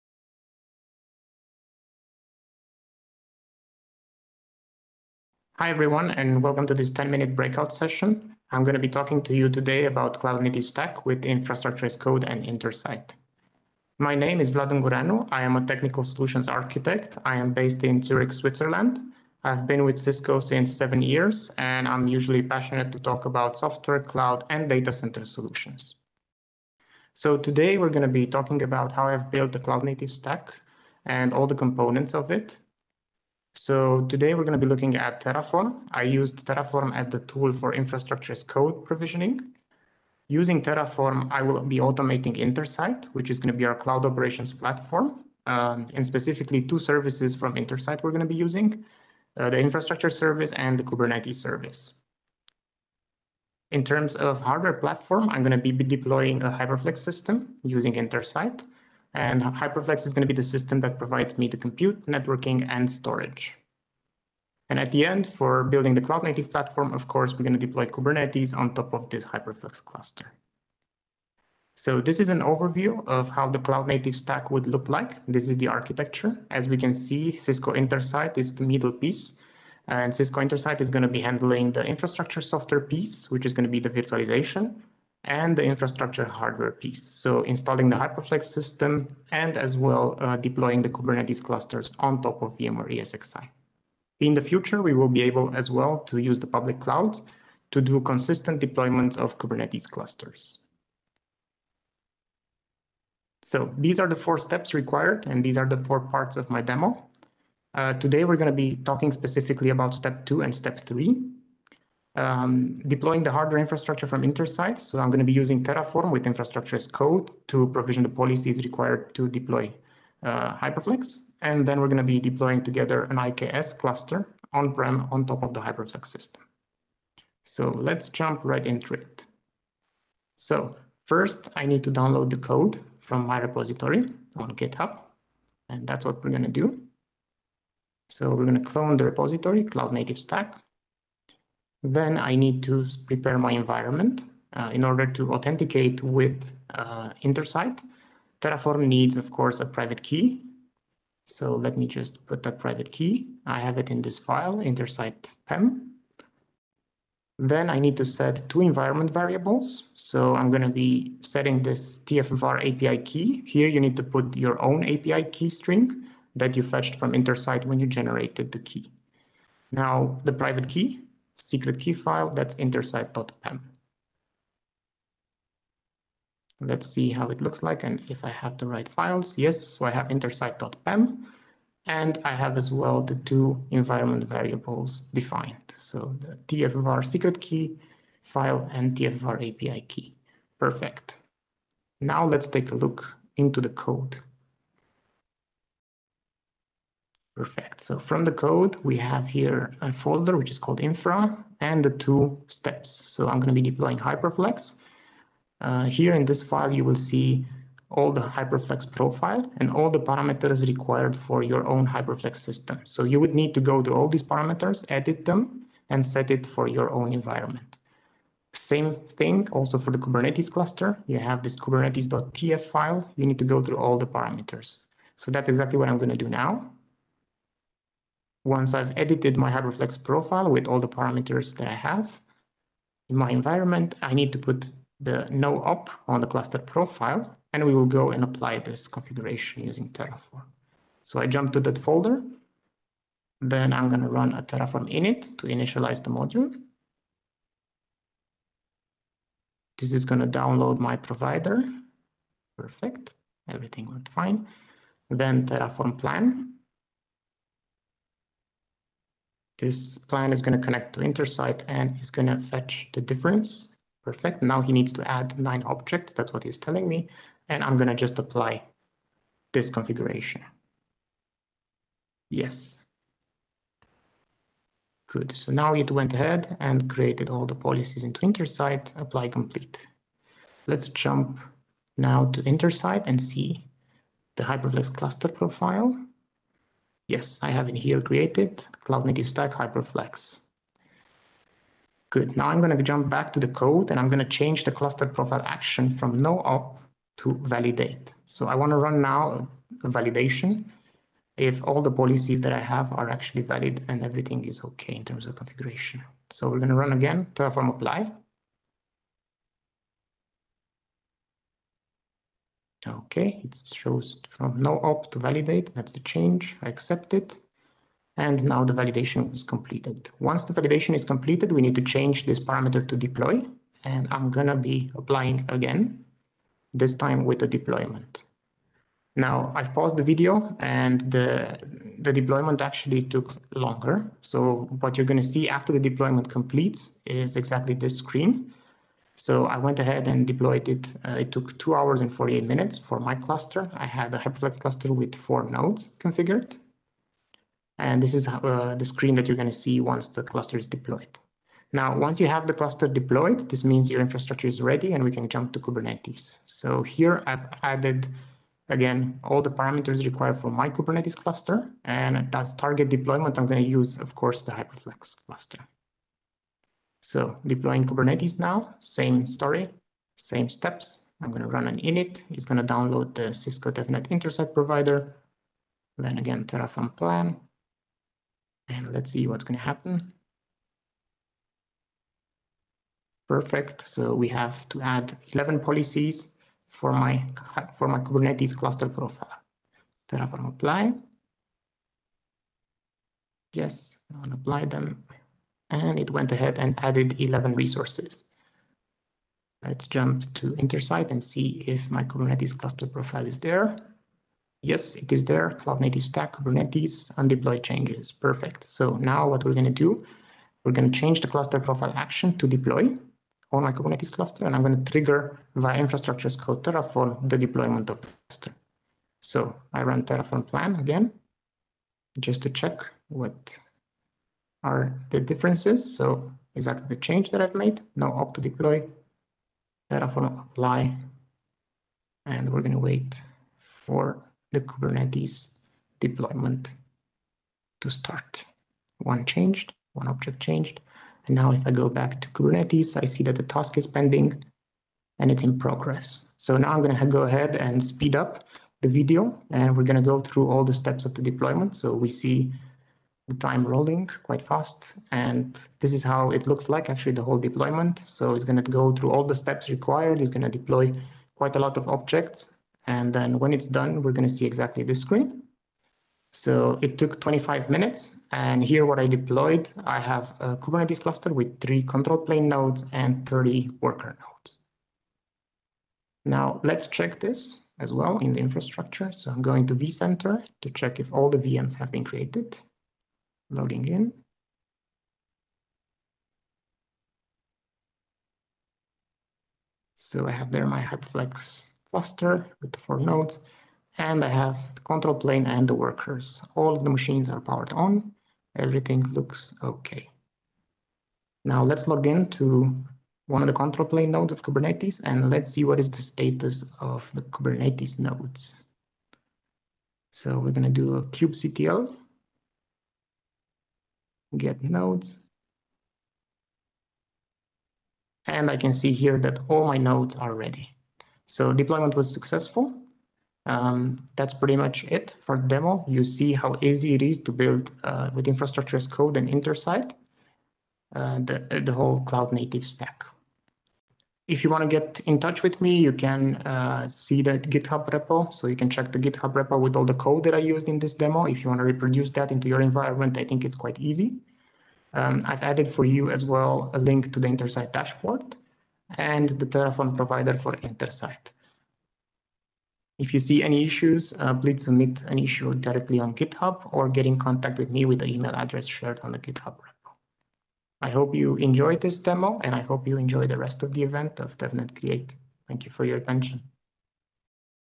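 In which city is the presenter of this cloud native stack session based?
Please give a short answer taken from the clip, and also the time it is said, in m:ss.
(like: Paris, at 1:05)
Zurich, at 0:18.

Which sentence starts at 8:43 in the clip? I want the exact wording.
Um, that's pretty much it for demo.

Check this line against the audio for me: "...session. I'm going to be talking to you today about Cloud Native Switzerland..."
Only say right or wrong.
wrong.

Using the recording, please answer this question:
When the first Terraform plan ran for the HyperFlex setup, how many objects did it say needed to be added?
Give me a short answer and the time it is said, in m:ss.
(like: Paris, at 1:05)
9, at 4:25.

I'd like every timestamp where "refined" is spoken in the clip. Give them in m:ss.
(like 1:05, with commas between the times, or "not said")
not said.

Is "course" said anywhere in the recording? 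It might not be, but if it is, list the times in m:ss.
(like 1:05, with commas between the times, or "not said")
1:07, 2:29, 6:04.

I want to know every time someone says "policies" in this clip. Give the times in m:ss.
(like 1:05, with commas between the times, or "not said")
1:58, 4:37, 5:01, 6:25.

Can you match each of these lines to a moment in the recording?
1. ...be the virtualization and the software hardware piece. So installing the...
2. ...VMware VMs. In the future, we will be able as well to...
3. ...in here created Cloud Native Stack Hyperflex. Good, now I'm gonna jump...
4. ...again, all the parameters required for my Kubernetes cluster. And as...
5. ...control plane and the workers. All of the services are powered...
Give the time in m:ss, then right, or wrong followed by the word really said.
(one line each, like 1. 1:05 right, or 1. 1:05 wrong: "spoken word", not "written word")
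1. 1:23 wrong: "infrastructure", not "software"
2. 1:32 wrong: "ESXi", not "VMs"
3. 4:47 right
4. 5:58 right
5. 8:14 wrong: "machines", not "services".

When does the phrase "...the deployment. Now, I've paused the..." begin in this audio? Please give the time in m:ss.
5:27.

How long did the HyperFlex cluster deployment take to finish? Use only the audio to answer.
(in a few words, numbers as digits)
2 hours 48 minutes.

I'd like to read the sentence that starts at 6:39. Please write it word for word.
Let's jump to Intersight and see if my Kubernetes cluster profile is there.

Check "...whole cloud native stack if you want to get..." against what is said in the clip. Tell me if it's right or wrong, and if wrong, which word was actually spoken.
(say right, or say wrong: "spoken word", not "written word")
right.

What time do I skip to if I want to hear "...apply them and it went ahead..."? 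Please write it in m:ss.
6:34.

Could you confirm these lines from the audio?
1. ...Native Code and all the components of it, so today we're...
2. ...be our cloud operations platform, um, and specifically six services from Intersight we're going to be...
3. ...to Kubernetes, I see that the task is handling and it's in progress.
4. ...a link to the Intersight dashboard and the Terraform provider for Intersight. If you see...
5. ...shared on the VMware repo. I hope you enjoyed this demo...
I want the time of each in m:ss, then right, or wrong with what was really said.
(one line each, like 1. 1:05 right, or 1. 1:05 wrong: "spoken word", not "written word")
1. 0:29 wrong: "Stack", not "Code"
2. 0:43 wrong: "two", not "six"
3. 7:22 wrong: "pending", not "handling"
4. 9:06 right
5. 9:18 wrong: "GitHub", not "VMware".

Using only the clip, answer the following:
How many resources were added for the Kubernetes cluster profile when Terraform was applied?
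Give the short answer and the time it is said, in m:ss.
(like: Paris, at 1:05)
11, at 6:25.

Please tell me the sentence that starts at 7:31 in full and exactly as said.
So we see the time rolling quite fast.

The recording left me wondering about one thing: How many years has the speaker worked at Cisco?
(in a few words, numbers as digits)
7.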